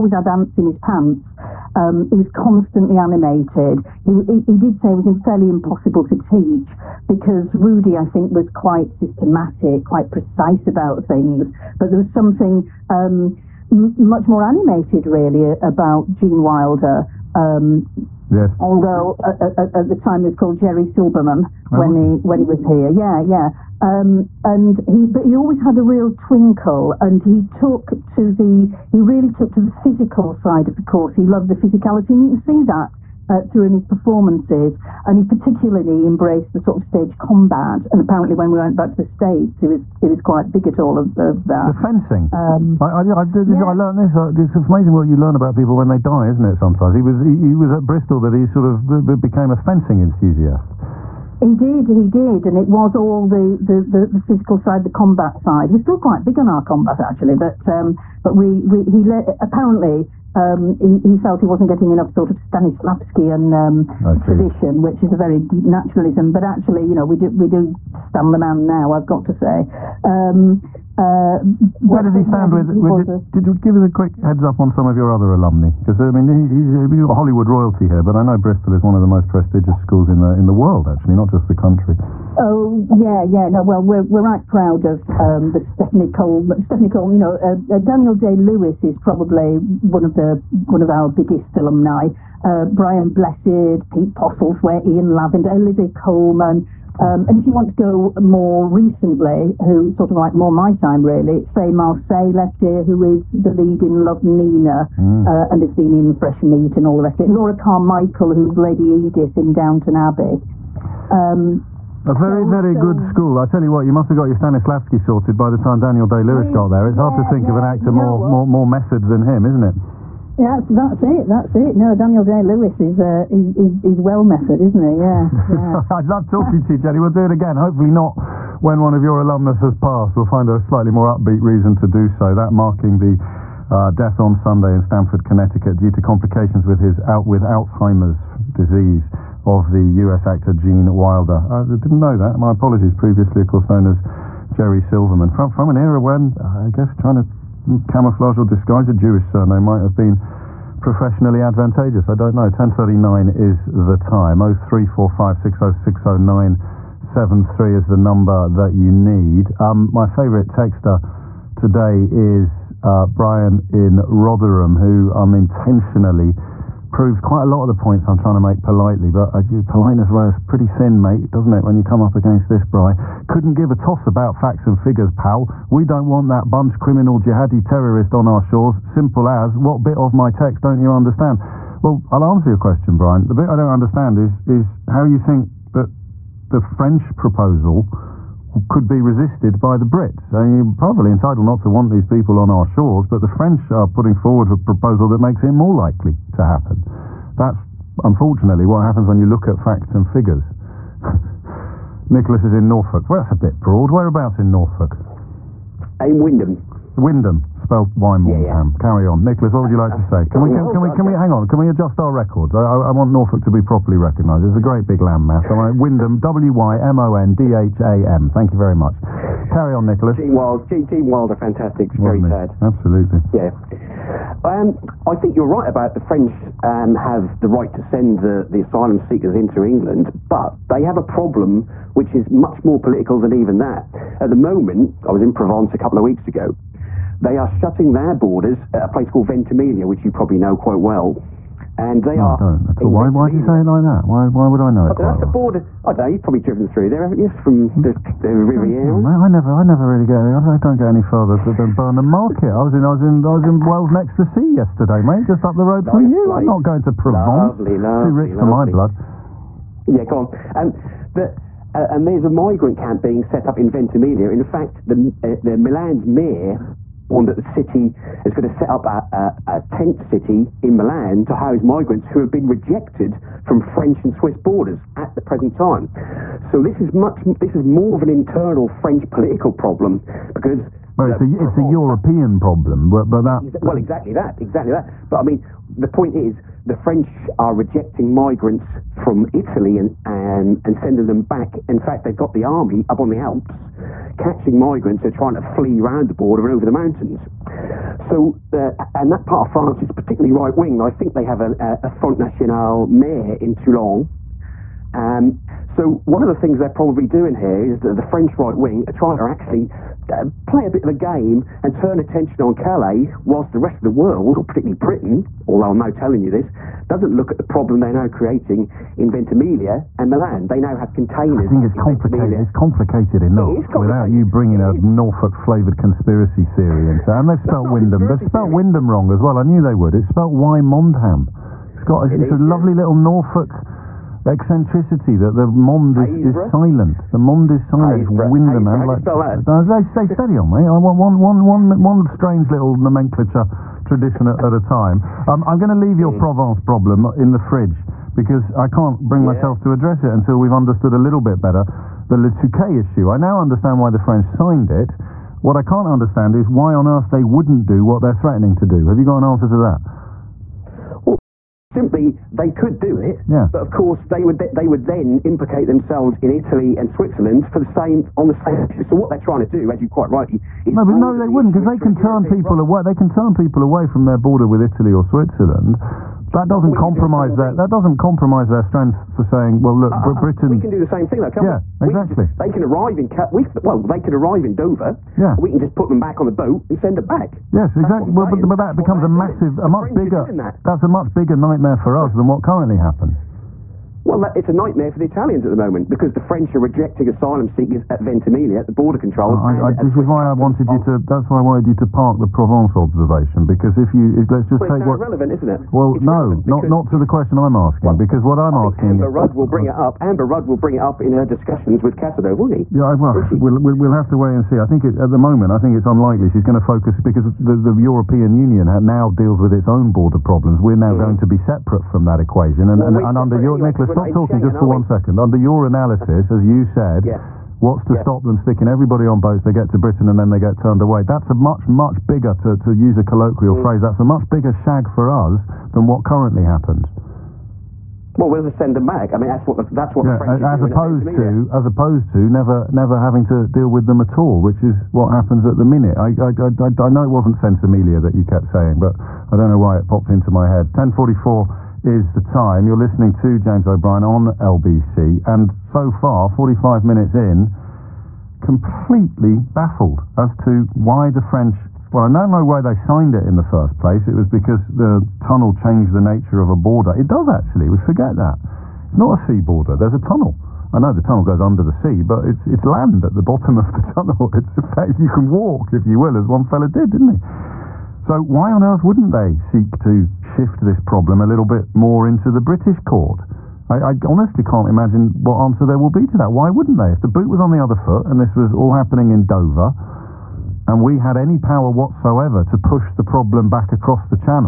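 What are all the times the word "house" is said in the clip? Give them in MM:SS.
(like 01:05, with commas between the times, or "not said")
04:31.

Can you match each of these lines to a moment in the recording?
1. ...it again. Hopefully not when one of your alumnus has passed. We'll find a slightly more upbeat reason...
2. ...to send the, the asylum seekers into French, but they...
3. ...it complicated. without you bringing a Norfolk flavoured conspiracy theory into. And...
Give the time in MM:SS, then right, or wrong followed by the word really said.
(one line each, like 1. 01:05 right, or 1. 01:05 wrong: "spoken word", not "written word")
1. 02:07 right
2. 03:47 wrong: "England", not "French"
3. 05:23 right.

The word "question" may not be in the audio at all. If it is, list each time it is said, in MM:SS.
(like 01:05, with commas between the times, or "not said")
03:02, 06:47.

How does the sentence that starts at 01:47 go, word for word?
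Laura Carmichael, who's Lady Edith in Downton Abbey.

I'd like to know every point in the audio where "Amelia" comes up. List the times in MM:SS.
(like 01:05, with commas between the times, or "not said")
07:27.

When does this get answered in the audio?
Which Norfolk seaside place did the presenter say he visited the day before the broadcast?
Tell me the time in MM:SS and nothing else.
04:13.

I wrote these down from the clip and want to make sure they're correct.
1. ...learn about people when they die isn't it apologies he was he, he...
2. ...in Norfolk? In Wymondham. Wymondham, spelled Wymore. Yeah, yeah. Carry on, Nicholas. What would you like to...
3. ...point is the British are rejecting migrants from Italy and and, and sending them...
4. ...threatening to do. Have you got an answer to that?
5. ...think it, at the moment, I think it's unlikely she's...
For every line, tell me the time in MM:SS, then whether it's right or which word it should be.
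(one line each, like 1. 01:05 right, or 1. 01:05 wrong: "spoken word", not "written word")
1. 00:45 wrong: "sometimes", not "apologies"
2. 03:24 right
3. 04:45 wrong: "French", not "British"
4. 05:58 right
5. 06:54 right.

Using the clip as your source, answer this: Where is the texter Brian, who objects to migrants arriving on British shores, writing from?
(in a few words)
Rotherham.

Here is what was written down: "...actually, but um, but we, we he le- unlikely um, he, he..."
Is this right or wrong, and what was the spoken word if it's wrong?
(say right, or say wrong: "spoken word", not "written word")
wrong: "apparently", not "unlikely".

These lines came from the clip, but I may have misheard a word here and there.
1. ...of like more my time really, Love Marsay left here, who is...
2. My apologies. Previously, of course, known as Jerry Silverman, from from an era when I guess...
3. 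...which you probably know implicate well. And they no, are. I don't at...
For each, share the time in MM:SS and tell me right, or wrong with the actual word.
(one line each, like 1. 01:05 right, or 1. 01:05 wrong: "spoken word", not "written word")
1. 01:40 wrong: "Faye", not "Love"
2. 02:22 right
3. 03:59 wrong: "quite", not "implicate".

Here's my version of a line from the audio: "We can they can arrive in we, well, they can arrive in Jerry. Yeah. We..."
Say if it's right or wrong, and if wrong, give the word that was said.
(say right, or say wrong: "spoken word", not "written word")
wrong: "Dover", not "Jerry".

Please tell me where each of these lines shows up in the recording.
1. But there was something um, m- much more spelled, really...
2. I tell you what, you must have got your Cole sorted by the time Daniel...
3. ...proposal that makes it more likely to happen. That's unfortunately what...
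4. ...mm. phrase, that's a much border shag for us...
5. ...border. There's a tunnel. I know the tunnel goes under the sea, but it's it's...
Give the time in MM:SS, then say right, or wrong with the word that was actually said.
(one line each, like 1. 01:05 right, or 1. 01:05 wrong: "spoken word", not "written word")
1. 00:11 wrong: "animated", not "spelled"
2. 01:53 wrong: "Stanislavski", not "Cole"
3. 03:14 right
4. 07:13 wrong: "bigger", not "border"
5. 07:49 right.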